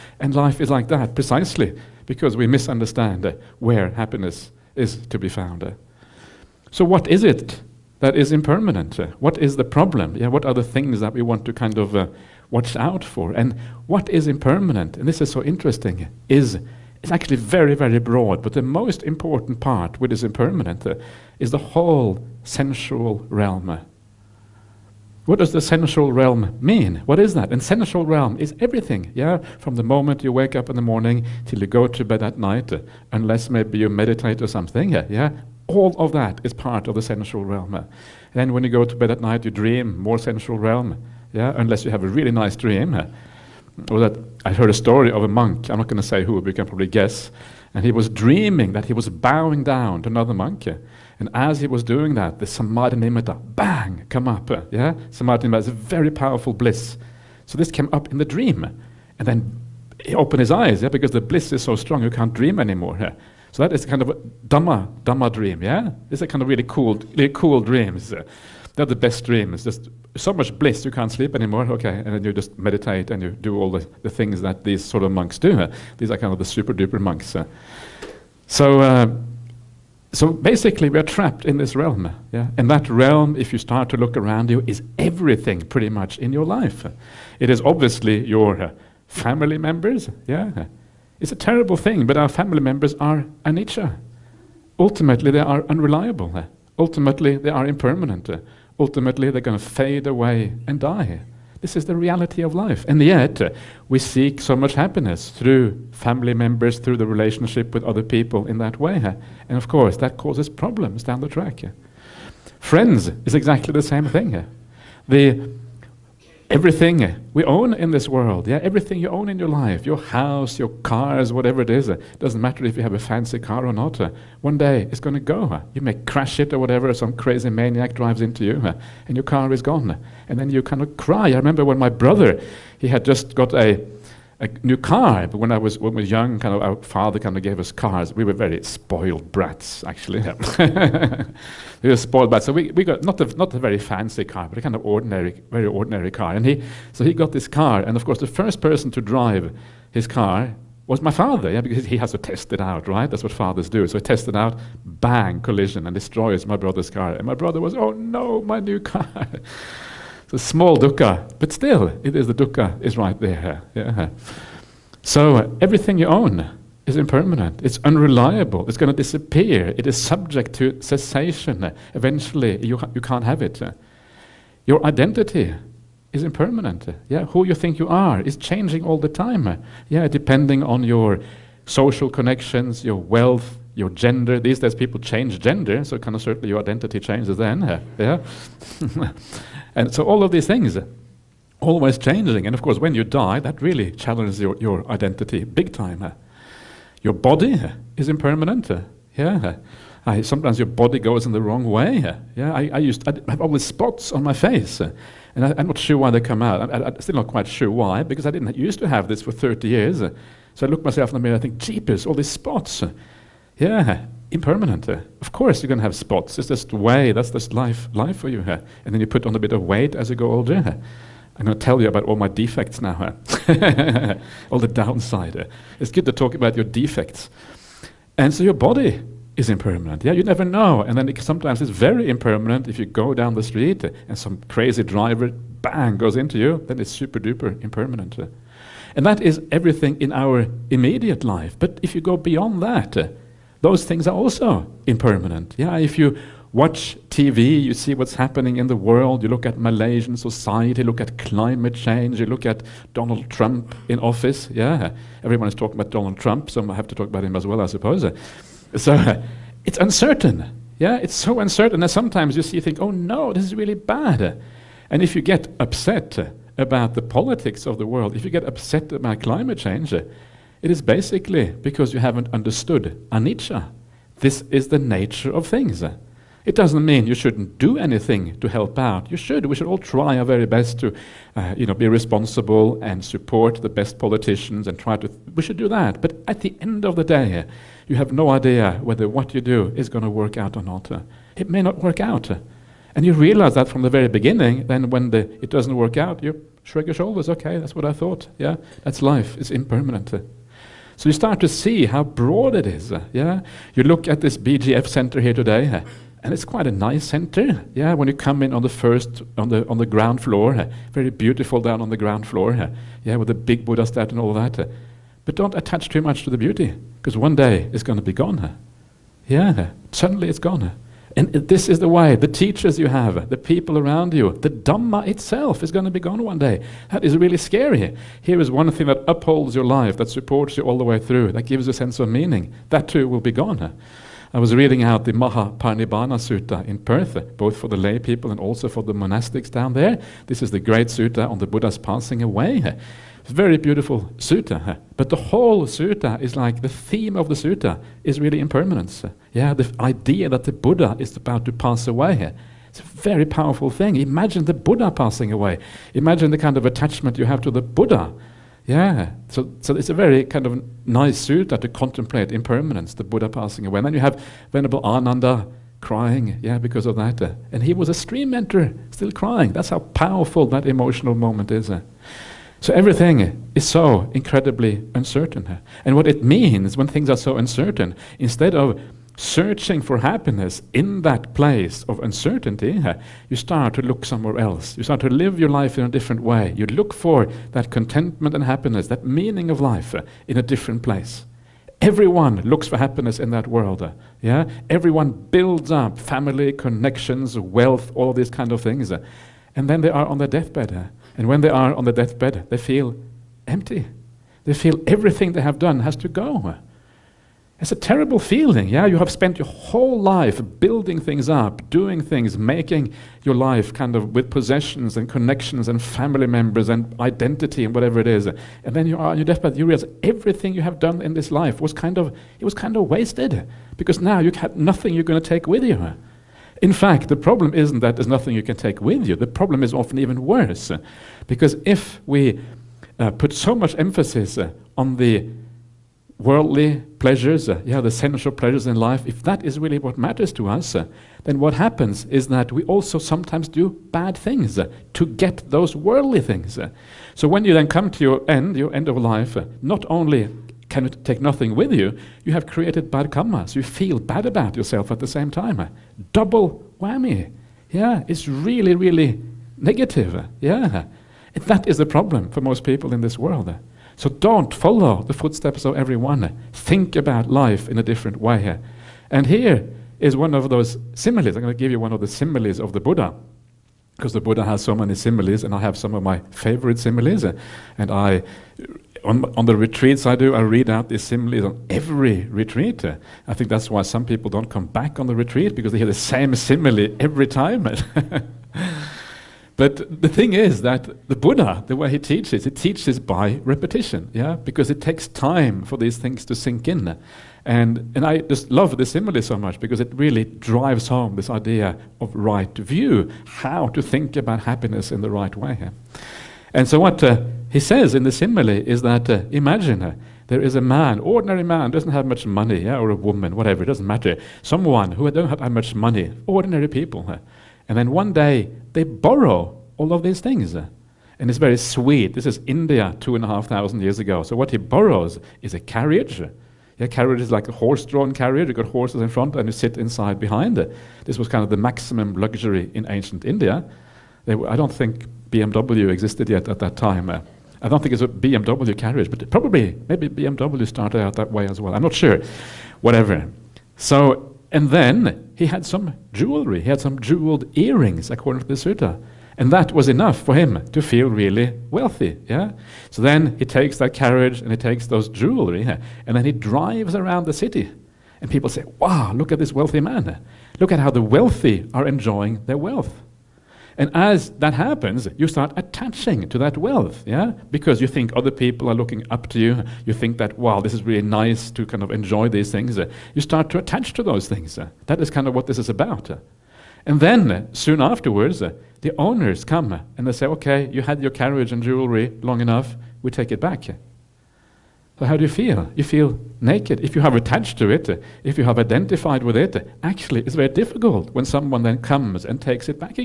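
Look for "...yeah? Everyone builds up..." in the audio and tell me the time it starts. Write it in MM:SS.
06:34.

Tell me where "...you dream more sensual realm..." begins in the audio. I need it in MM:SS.
00:39.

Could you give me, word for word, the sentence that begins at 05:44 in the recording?
But the whole sutta is like the theme of the sutta is really impermanence.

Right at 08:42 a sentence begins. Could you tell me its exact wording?
This is India, two and a half thousand years ago.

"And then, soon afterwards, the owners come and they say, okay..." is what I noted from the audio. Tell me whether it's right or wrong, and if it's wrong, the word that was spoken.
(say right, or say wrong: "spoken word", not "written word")
right.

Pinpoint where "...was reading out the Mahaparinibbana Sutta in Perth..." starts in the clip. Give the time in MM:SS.
05:34.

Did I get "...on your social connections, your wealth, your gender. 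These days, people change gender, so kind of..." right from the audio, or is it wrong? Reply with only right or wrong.
right.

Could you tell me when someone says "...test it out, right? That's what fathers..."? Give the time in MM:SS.
02:32.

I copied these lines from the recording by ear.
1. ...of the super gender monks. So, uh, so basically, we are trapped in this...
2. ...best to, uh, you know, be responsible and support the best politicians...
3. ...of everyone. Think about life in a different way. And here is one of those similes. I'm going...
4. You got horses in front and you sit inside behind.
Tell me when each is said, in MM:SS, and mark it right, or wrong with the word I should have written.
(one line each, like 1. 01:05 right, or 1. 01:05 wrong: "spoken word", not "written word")
1. 01:16 wrong: "duper", not "gender"
2. 04:40 right
3. 07:45 right
4. 08:48 right.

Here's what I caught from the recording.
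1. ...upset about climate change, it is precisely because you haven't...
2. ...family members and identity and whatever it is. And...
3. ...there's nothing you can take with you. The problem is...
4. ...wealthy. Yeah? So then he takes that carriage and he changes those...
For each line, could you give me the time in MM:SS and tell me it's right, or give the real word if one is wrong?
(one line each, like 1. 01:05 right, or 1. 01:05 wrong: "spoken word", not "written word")
1. 04:28 wrong: "basically", not "precisely"
2. 06:55 right
3. 07:07 right
4. 09:11 wrong: "takes", not "changes".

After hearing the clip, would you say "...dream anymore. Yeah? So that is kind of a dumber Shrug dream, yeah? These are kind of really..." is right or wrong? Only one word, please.
wrong.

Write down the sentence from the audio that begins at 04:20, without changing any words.
Yeah, it's so uncertain that sometimes you see, you think, oh no, this is really bad.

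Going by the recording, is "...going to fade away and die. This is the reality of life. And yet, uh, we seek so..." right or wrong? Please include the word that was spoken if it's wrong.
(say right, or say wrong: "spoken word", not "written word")
right.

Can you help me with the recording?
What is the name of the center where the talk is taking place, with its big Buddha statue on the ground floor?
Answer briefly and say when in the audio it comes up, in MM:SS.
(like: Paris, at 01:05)
BGF center, at 05:04.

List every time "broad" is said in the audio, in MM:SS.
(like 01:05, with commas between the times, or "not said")
00:17, 05:02.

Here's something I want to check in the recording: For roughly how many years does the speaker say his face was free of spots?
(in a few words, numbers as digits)
30.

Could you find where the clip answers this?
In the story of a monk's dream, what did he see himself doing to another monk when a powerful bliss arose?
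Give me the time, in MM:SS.
00:49.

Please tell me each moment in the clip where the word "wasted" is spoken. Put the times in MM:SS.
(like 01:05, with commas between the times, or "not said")
07:02.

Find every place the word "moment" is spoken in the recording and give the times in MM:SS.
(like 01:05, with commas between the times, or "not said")
00:29, 06:11.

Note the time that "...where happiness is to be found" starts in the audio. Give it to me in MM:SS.
00:03.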